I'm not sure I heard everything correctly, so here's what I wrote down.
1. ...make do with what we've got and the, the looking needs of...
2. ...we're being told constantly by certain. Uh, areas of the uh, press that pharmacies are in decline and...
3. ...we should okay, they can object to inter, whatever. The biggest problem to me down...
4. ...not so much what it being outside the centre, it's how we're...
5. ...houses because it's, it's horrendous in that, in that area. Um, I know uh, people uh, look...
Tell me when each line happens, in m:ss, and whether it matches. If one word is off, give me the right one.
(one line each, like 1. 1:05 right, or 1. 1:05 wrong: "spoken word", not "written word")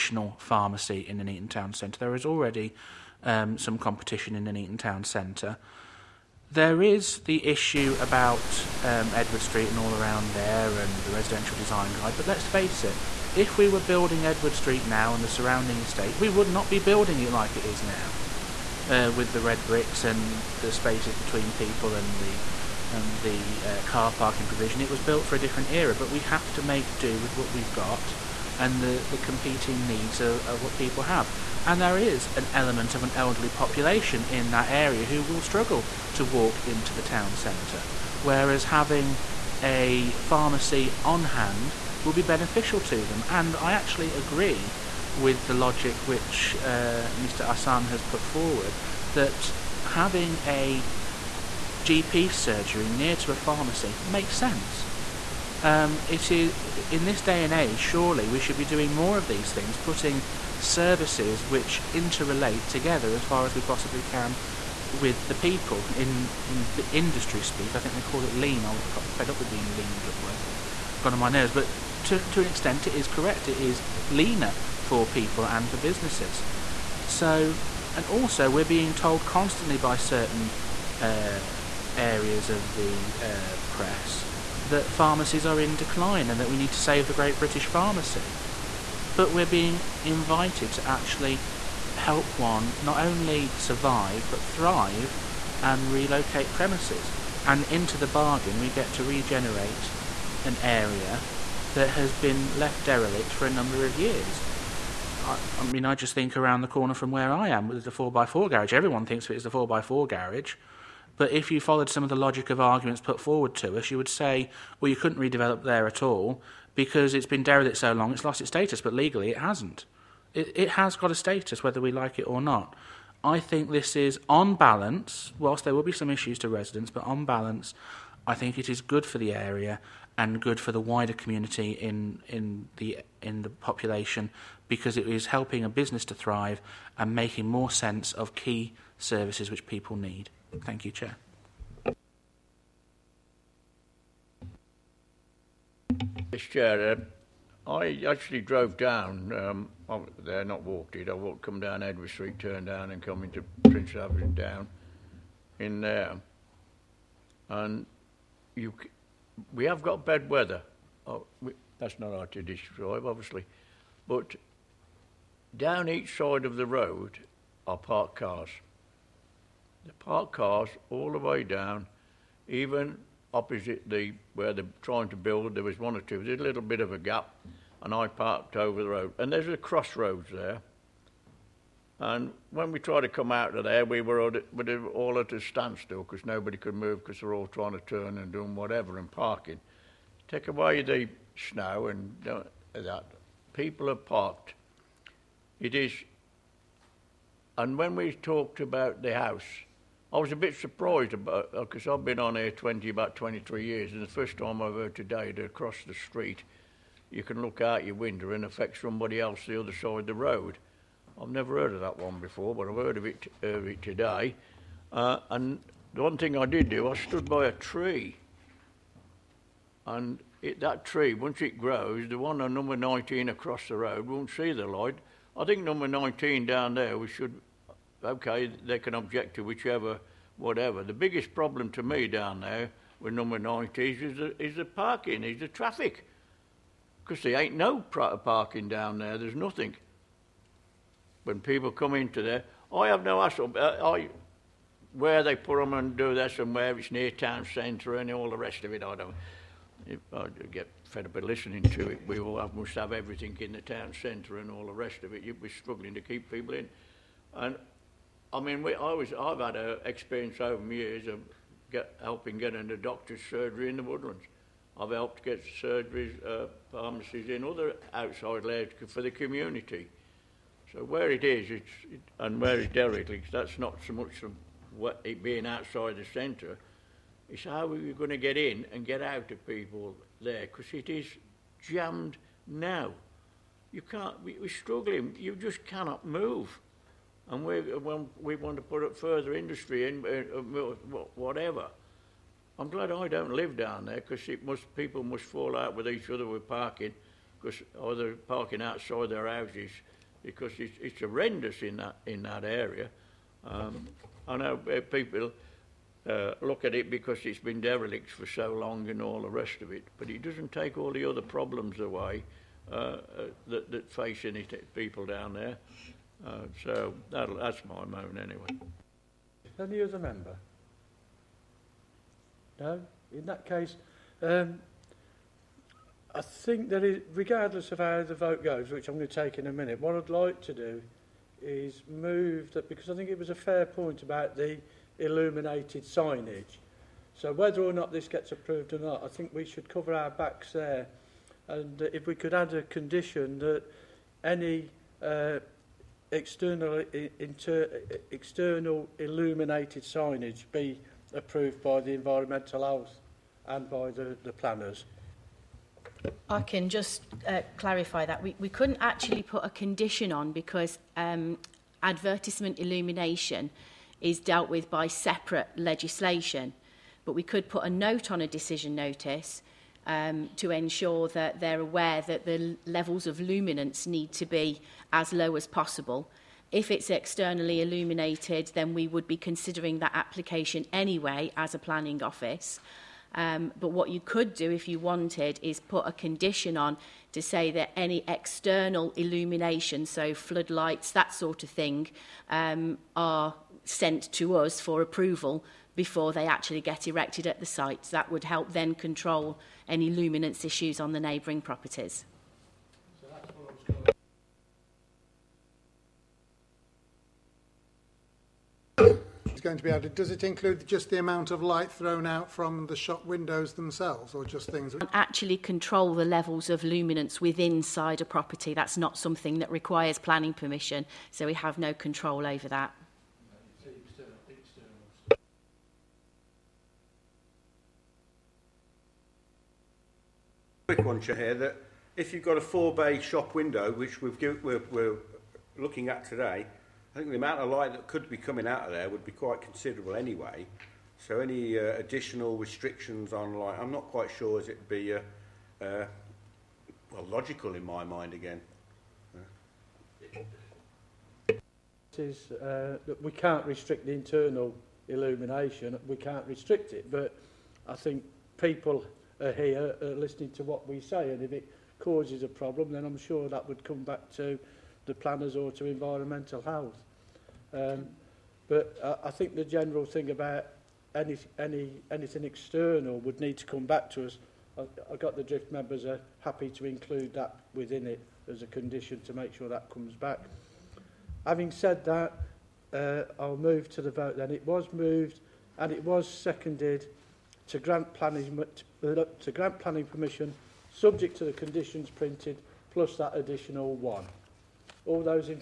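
1. 0:26 wrong: "competing", not "looking"
2. 1:18 right
3. 3:46 wrong: "whichever", not "inter"
4. 4:33 right
5. 4:59 right.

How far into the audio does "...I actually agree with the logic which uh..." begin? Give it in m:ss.
0:43.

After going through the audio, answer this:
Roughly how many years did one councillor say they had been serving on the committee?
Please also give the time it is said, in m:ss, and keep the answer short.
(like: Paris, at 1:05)
23, at 3:23.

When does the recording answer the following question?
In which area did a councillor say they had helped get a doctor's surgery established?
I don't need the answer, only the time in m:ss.
4:23.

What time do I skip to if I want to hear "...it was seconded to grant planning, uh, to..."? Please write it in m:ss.
8:05.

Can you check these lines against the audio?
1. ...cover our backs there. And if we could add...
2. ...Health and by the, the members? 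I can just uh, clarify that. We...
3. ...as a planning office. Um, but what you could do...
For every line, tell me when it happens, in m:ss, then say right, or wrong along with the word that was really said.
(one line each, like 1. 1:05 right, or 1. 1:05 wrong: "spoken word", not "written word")
1. 5:39 right
2. 5:52 wrong: "planners", not "members"
3. 6:21 right.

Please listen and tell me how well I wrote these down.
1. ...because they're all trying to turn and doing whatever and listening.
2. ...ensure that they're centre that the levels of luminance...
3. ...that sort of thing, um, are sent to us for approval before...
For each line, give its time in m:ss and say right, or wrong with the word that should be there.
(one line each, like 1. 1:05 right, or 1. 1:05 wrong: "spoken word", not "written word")
1. 3:07 wrong: "parking", not "listening"
2. 6:10 wrong: "aware", not "centre"
3. 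6:30 right.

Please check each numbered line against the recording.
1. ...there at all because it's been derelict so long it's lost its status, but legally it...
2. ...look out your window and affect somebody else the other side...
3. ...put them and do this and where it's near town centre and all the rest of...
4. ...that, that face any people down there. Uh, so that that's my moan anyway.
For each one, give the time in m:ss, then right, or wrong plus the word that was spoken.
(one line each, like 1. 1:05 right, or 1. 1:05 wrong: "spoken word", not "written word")
1. 1:55 right
2. 3:27 right
3. 4:05 right
4. 5:13 right.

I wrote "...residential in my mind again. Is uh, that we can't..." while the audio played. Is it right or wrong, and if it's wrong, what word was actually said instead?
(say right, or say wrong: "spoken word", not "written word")
wrong: "logical", not "residential".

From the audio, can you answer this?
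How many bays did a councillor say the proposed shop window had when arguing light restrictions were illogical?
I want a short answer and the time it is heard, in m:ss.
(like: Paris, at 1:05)
4, at 7:12.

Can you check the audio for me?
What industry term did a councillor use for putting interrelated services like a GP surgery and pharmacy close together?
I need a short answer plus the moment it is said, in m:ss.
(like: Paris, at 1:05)
lean, at 1:08.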